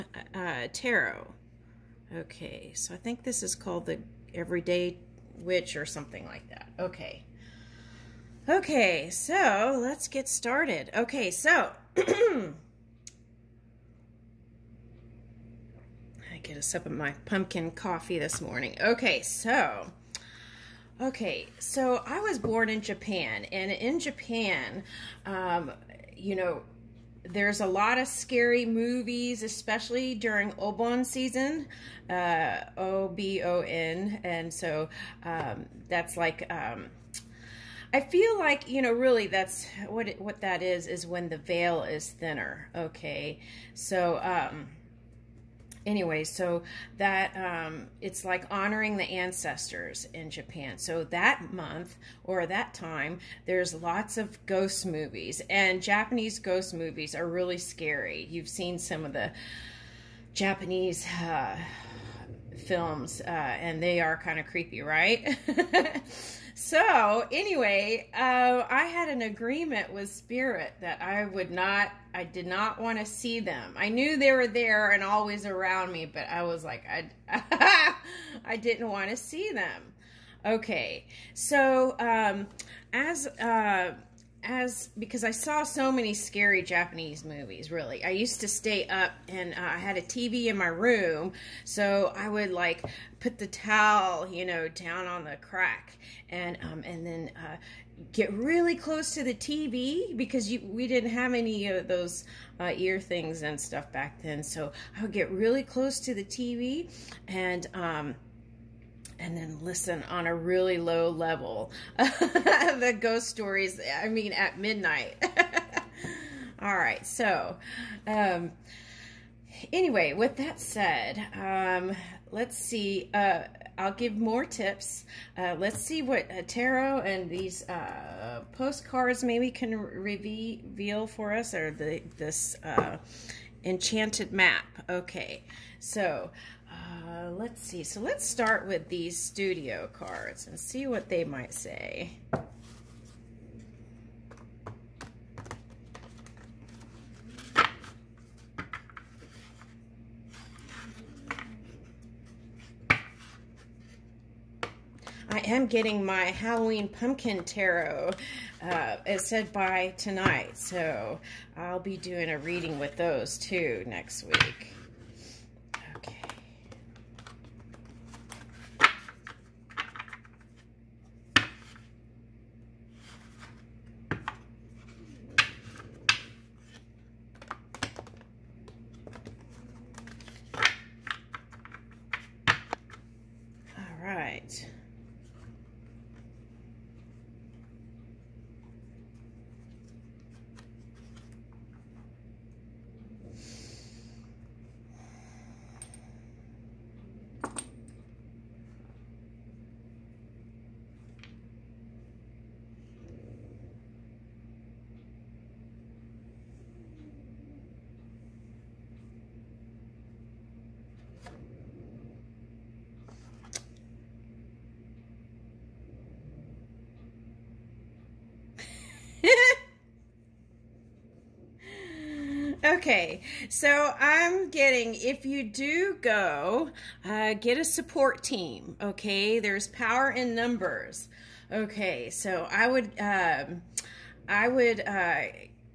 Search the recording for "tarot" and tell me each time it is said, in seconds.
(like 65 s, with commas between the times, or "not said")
0 s, 126 s, 157 s.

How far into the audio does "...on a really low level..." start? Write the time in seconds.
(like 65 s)
110 s.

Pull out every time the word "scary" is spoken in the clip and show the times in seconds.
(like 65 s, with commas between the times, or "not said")
28 s, 57 s, 86 s.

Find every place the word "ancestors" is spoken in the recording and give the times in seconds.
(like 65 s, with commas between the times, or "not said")
49 s.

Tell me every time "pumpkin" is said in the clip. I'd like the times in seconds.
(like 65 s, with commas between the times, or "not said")
17 s, 156 s.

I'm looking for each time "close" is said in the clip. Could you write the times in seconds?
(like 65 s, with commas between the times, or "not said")
98 s, 105 s.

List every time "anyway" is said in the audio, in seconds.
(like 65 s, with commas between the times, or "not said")
45 s, 67 s, 119 s.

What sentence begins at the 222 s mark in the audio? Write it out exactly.
Okay, so I'm getting, if you do go, uh, get a support team, okay?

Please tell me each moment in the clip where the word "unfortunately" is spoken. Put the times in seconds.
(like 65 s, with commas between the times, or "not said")
not said.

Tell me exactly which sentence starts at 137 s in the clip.
So let's start with these studio cards and see what they might say.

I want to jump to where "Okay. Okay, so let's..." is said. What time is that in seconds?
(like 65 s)
6 s.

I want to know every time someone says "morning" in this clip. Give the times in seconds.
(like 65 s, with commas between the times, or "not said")
18 s.